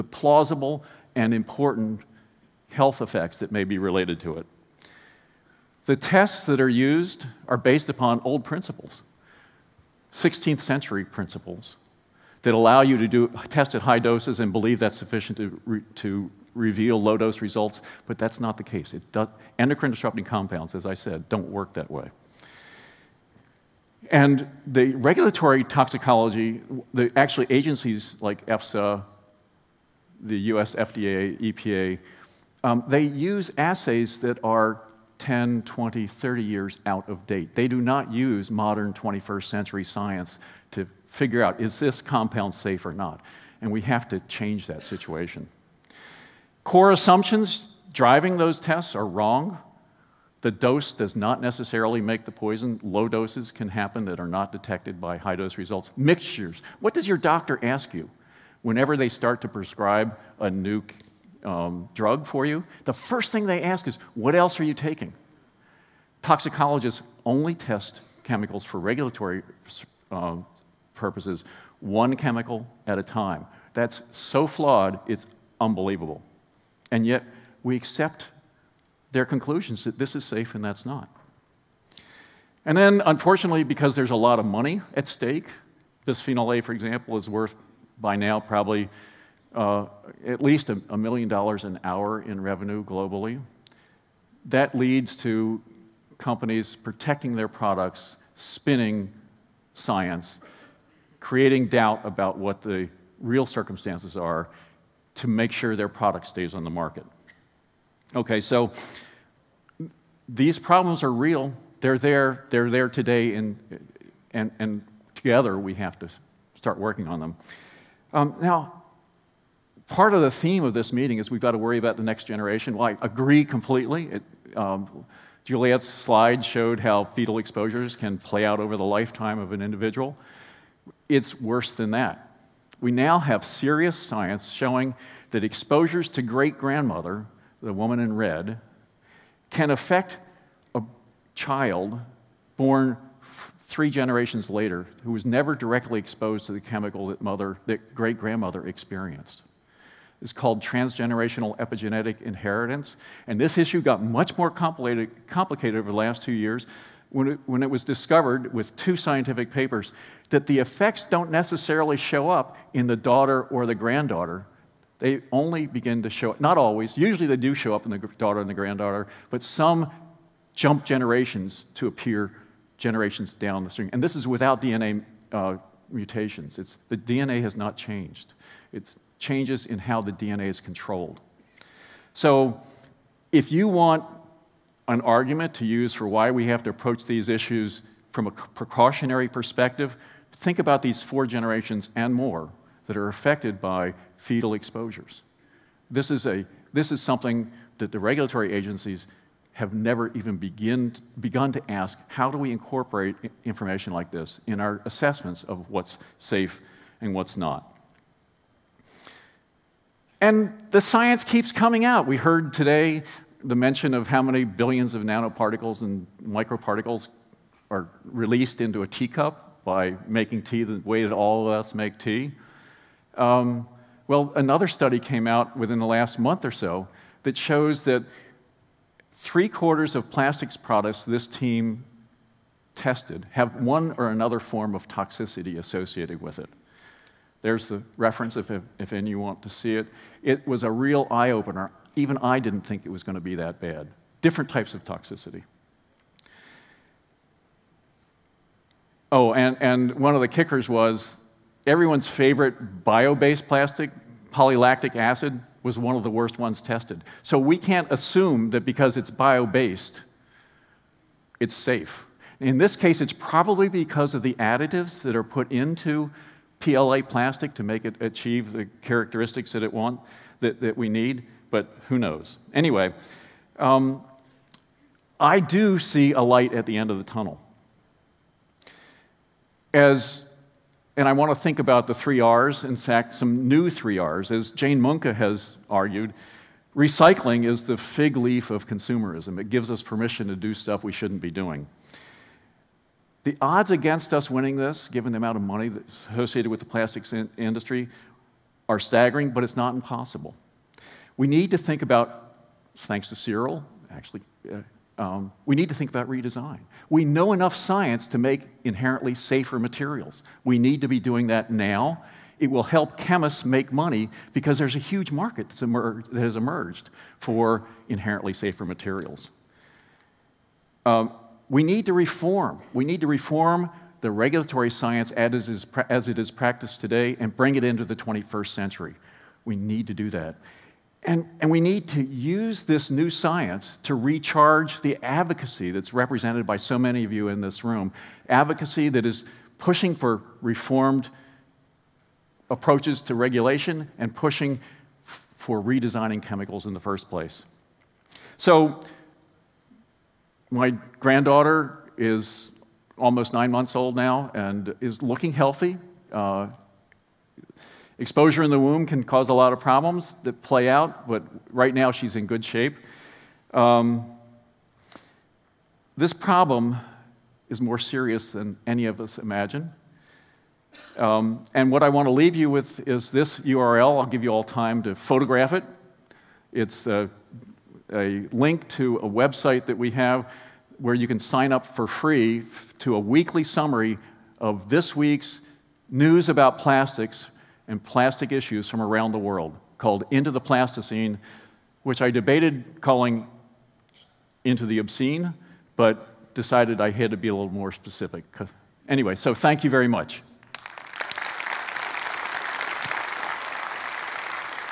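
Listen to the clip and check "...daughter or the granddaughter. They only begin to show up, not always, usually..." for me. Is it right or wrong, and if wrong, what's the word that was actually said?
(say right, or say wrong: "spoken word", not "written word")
right.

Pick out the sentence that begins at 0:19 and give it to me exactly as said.
Does, endocrine disrupting compounds, as I said, don't work that way.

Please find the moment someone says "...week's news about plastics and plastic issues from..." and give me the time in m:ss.
6:24.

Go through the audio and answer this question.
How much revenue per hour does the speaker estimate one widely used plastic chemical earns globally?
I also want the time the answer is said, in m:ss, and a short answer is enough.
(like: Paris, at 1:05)
$1 million an hour, at 1:30.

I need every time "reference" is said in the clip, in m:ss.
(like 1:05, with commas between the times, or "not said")
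3:57.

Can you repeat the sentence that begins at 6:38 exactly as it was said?
Anyway, so thank you very much.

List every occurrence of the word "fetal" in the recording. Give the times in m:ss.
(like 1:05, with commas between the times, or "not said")
2:07, 3:14.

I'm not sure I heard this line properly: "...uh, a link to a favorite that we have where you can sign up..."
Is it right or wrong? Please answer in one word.
wrong.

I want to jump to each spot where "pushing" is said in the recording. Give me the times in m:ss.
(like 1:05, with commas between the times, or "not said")
5:39, 5:44.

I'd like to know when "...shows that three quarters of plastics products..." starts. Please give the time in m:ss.
3:47.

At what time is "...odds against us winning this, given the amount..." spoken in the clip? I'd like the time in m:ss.
4:53.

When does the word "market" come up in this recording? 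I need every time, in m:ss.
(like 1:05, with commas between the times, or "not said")
1:46, 5:15.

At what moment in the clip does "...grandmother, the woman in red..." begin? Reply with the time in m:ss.
2:16.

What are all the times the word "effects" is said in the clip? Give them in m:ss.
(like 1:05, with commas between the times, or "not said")
0:03, 2:40.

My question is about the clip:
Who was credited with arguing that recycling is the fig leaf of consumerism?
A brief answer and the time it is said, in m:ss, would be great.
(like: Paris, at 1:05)
Jane Muncke, at 4:44.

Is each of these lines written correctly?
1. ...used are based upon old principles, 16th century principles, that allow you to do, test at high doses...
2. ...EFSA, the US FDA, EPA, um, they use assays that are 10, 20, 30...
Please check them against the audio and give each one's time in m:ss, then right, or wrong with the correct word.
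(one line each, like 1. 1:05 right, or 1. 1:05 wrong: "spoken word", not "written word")
1. 0:06 right
2. 0:28 right.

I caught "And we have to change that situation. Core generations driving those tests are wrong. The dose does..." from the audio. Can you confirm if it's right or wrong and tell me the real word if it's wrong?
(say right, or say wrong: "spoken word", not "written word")
wrong: "assumptions", not "generations".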